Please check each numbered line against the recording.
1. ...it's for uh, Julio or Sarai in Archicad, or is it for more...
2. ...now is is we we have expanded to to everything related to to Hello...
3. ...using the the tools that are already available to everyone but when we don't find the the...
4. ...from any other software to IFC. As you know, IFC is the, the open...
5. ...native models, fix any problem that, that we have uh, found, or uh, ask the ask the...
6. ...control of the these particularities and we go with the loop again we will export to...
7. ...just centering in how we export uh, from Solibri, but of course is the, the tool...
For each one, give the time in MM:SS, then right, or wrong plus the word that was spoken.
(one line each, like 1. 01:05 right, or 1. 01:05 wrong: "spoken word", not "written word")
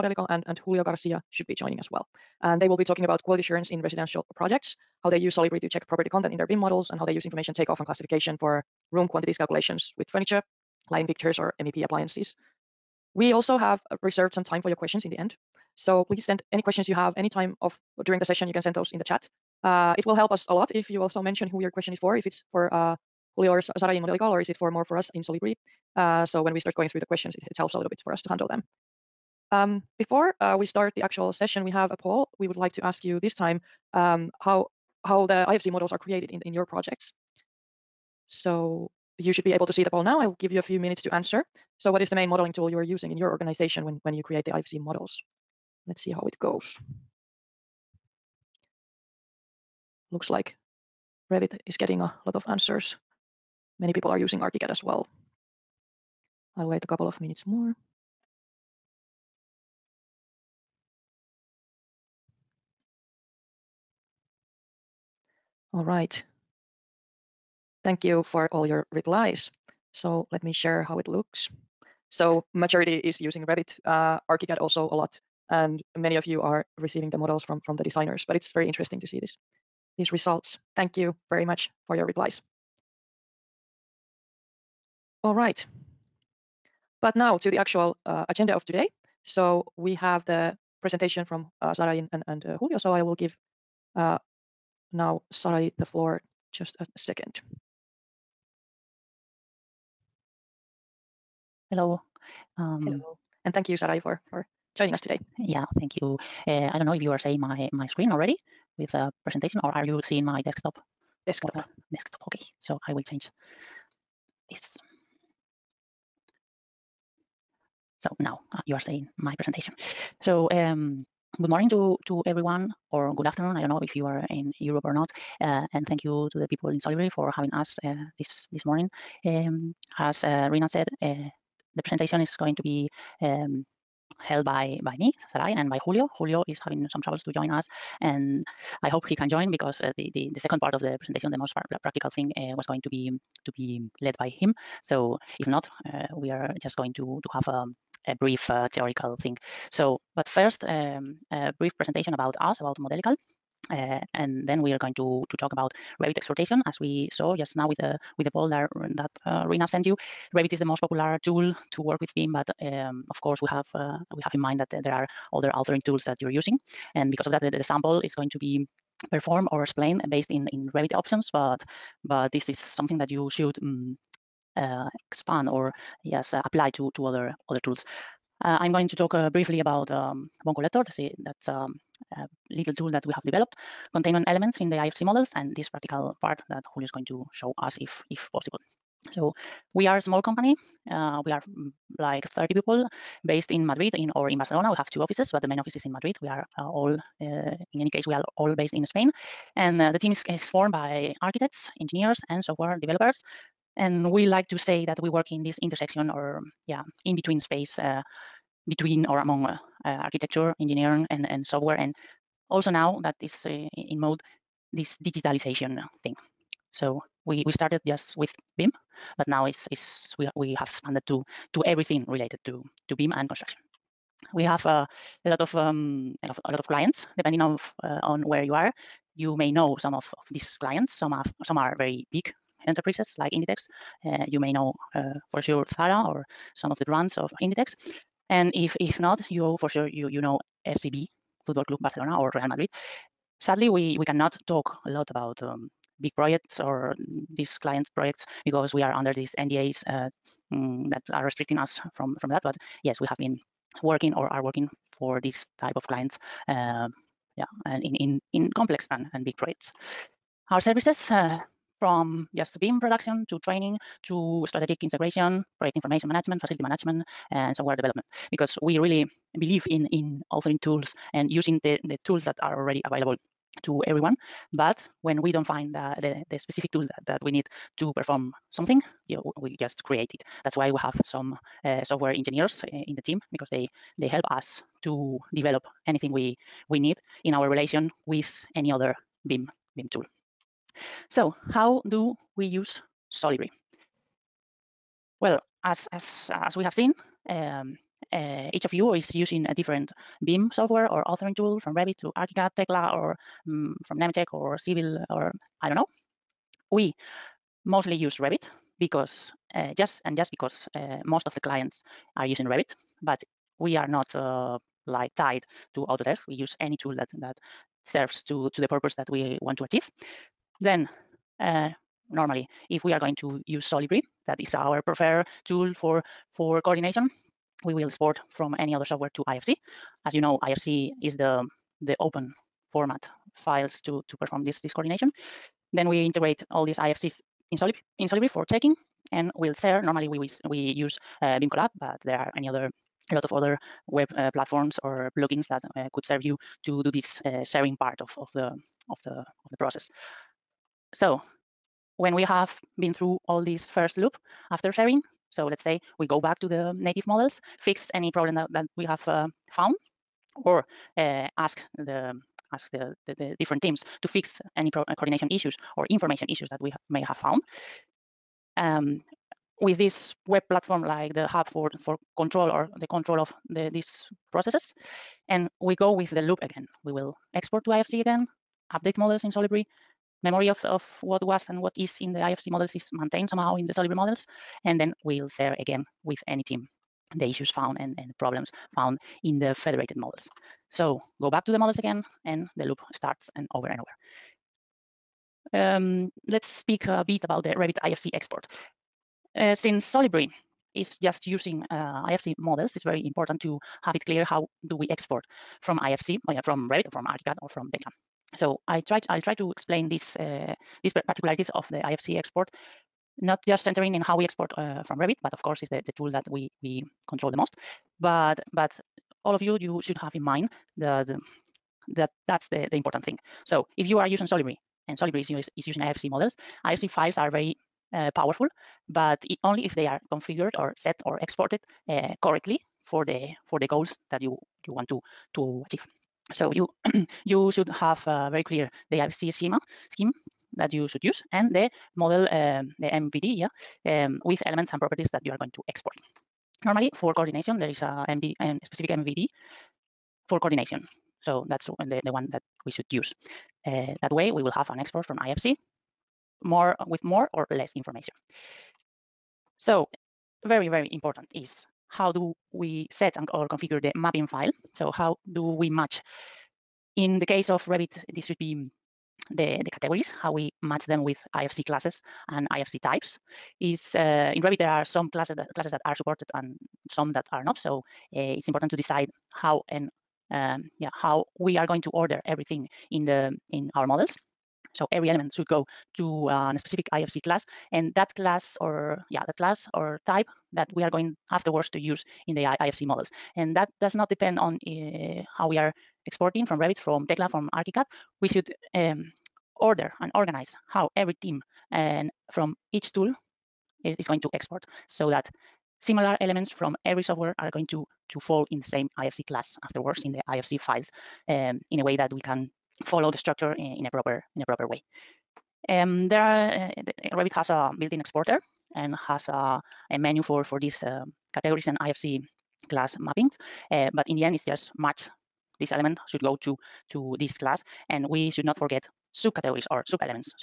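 1. 00:22 wrong: "Modelical", not "Archicad"
2. 03:39 wrong: "BIM", not "Hello"
3. 04:31 right
4. 05:28 right
5. 05:56 right
6. 06:12 wrong: "processes", not "particularities"
7. 06:53 wrong: "Revit", not "Solibri".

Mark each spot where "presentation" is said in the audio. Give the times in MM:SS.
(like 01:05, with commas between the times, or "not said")
01:30, 01:49, 01:59, 02:11, 02:21, 02:31.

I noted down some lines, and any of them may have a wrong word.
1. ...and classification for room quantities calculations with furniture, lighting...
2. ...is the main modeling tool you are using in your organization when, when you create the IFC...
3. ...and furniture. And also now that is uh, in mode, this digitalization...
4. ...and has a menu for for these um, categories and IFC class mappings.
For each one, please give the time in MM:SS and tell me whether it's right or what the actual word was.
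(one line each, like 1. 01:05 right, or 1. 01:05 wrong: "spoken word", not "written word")
1. 00:07 right
2. 00:42 right
3. 03:31 wrong: "software", not "furniture"
4. 08:38 right.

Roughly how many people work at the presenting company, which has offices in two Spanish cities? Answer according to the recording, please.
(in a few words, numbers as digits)
30.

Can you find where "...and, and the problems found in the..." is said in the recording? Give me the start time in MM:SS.
06:27.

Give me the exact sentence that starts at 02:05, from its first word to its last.
Uh, and thank you to the people in Solibri for having us uh, this this morning.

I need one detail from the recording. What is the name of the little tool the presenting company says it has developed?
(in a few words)
Bone Collector.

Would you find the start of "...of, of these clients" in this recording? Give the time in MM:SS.
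03:49.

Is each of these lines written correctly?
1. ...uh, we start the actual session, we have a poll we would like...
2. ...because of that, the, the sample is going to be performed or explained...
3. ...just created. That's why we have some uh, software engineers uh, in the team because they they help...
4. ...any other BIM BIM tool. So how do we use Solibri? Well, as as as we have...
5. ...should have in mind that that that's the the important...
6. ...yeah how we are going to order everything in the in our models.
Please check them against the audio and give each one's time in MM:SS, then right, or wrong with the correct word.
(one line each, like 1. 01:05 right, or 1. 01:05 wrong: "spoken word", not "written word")
1. 00:30 right
2. 02:47 right
3. 04:39 right
4. 04:48 right
5. 06:59 right
6. 08:00 right.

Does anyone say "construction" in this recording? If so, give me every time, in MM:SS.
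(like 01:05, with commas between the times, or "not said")
03:43.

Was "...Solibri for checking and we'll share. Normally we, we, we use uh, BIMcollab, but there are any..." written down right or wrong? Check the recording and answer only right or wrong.
right.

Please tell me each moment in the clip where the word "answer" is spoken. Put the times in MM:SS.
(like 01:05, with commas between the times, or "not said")
00:41, 00:52.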